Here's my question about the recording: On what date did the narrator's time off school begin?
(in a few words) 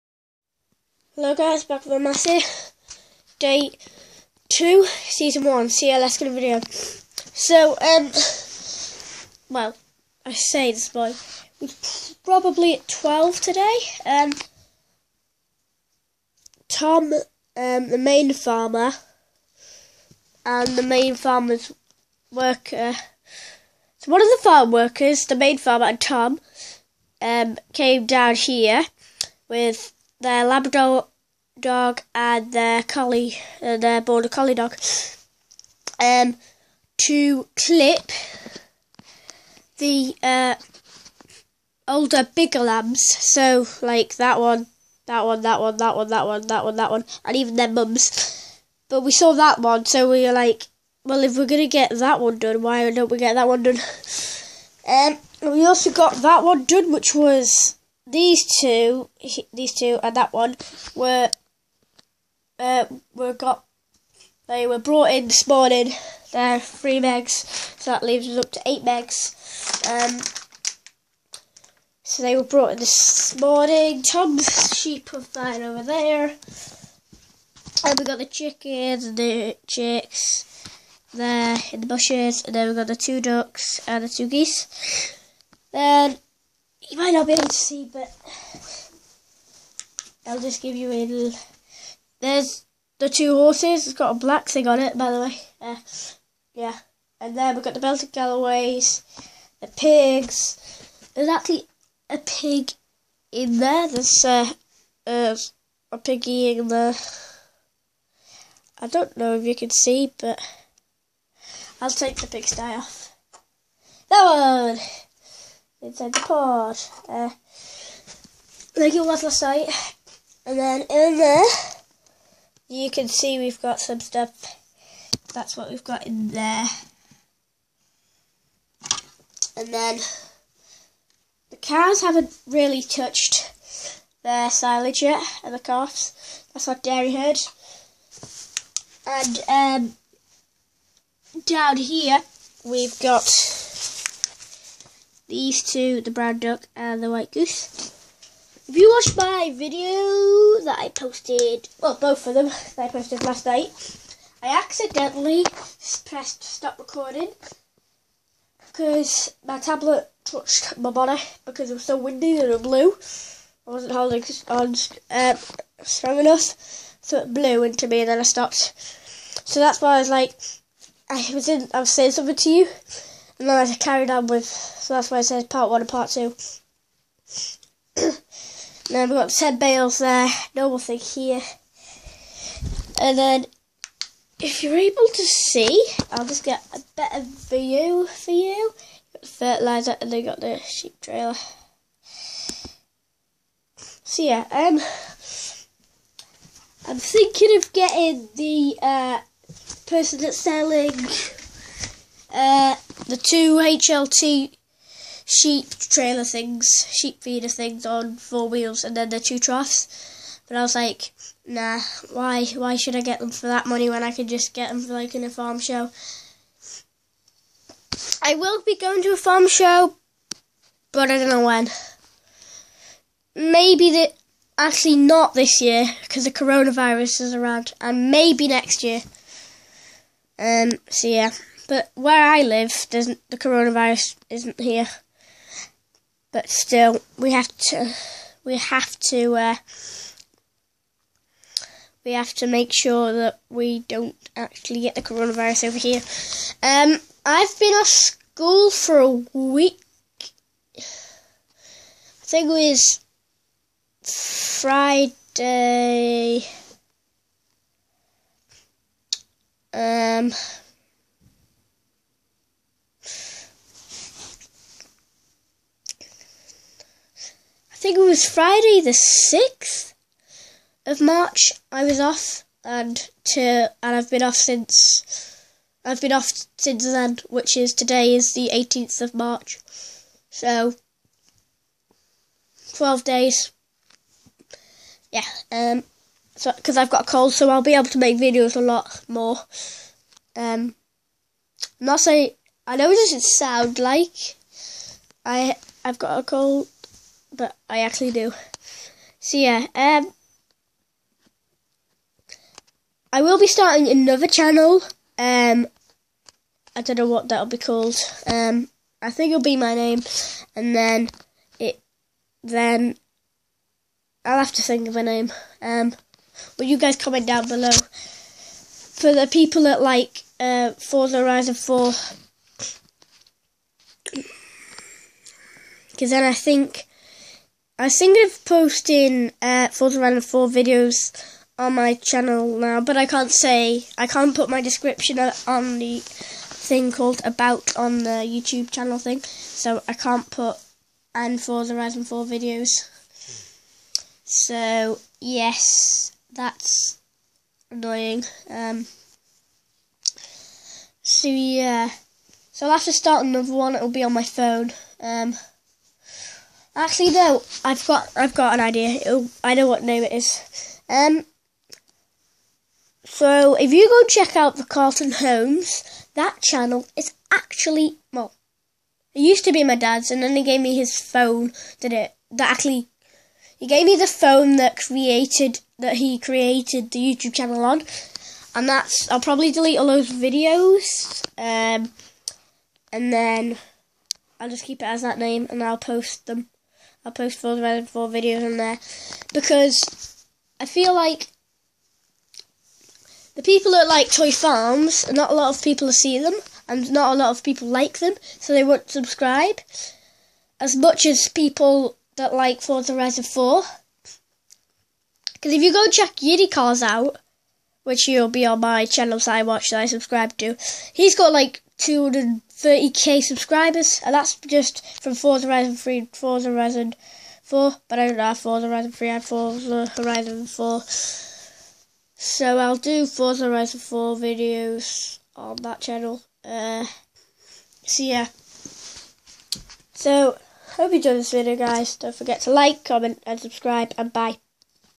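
6th of March.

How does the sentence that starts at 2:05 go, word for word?
That's what we've got in there.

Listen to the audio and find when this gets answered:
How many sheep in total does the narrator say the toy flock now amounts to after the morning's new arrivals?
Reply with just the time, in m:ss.
1:08.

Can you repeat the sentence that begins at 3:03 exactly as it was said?
And then, if you're able to see, I'll just get a better view for you.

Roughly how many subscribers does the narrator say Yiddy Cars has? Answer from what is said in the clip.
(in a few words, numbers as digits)
230k.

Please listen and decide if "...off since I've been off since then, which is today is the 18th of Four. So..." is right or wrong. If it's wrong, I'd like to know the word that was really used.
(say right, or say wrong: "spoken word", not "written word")
wrong: "March", not "Four".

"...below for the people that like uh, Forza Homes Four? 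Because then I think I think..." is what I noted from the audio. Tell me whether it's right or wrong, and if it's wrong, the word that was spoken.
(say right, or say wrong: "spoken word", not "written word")
wrong: "Horizon", not "Homes".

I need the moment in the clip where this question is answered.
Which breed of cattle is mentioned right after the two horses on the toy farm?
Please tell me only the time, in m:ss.
1:37.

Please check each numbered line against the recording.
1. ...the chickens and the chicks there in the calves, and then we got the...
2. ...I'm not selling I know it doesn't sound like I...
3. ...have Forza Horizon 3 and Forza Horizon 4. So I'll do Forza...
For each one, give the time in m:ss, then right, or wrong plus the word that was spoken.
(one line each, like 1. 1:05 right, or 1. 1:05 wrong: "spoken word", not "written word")
1. 1:18 wrong: "bushes", not "calves"
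2. 4:51 wrong: "saying", not "selling"
3. 6:58 right.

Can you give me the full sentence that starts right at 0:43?
So, like that one, that one, that one, that one, that one, that one, that one, and even their mums.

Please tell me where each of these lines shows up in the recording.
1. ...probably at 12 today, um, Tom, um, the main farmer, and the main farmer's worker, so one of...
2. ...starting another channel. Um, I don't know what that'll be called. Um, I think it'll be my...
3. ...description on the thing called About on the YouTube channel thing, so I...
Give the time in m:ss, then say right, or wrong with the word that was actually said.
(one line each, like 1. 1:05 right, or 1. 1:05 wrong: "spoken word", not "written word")
1. 0:12 right
2. 5:03 right
3. 5:34 right.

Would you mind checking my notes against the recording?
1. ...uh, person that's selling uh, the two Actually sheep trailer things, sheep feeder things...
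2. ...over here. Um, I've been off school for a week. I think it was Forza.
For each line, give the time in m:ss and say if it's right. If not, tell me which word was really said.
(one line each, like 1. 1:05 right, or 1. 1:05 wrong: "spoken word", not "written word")
1. 3:18 wrong: "HLT", not "Actually"
2. 4:05 wrong: "Friday", not "Forza".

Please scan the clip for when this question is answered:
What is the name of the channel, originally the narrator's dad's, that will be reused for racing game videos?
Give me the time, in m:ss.
6:04.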